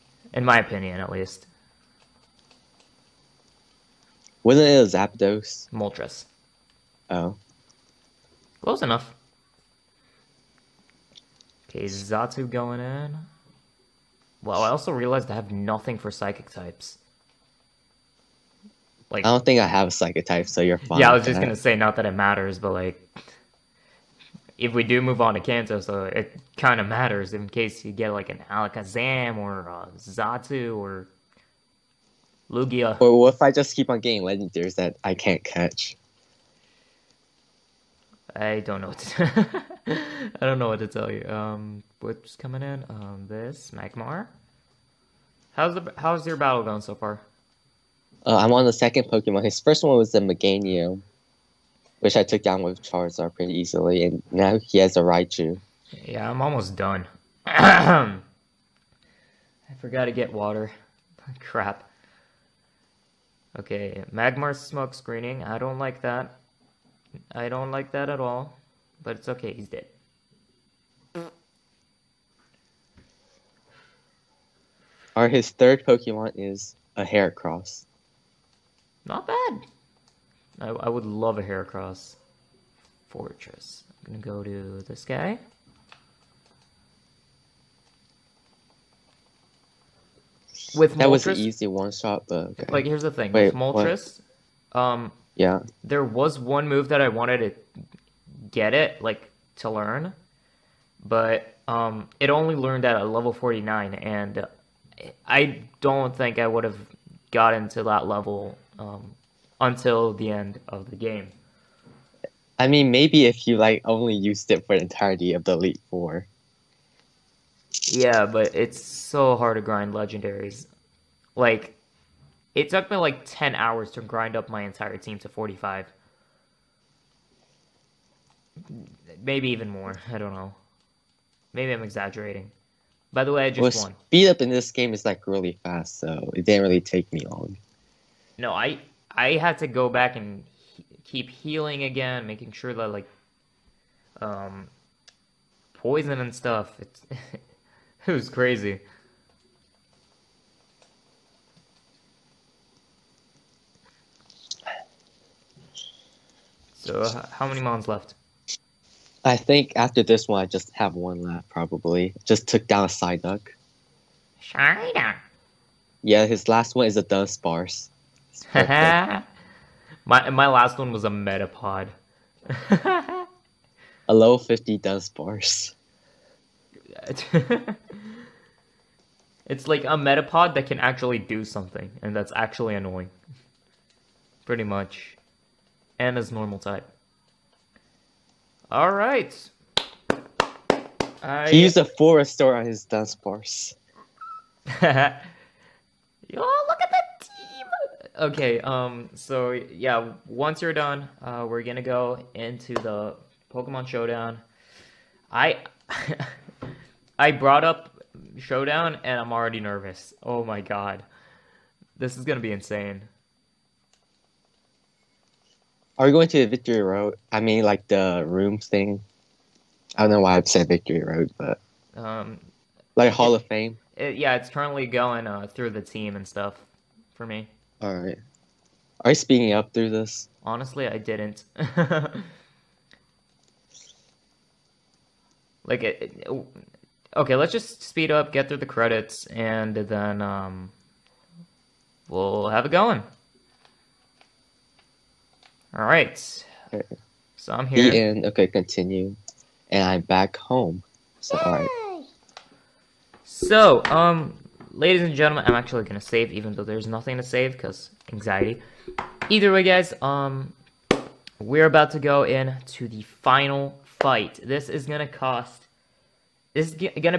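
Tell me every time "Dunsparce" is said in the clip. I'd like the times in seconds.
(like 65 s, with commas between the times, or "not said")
167 s, 174 s, 192 s.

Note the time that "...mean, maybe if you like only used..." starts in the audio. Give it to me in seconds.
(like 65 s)
112 s.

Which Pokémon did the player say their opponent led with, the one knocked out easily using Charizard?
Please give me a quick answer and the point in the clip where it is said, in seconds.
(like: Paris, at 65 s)
Meganium, at 50 s.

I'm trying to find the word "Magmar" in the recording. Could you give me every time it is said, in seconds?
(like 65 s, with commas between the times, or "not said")
43 s, 64 s.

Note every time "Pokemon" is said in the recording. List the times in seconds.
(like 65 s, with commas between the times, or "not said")
49 s, 75 s, 203 s.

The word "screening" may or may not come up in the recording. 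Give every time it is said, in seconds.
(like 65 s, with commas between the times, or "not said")
64 s.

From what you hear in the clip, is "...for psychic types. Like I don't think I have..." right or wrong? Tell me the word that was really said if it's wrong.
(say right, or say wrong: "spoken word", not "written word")
right.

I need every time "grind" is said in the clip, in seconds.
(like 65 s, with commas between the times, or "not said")
119 s, 124 s.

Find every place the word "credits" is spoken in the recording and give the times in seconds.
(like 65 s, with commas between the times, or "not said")
238 s.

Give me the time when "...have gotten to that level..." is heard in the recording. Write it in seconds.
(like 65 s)
106 s.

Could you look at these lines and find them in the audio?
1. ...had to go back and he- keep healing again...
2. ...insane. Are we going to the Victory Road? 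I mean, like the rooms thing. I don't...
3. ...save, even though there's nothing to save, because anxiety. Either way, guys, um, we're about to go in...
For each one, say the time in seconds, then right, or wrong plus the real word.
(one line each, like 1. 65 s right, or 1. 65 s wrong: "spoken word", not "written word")
1. 139 s right
2. 212 s right
3. 255 s right.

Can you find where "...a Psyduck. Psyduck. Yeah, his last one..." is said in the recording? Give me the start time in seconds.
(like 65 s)
162 s.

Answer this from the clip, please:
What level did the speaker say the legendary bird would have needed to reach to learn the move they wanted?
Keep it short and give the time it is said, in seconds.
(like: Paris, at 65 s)
49, at 103 s.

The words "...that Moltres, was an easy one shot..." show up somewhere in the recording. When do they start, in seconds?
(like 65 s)
90 s.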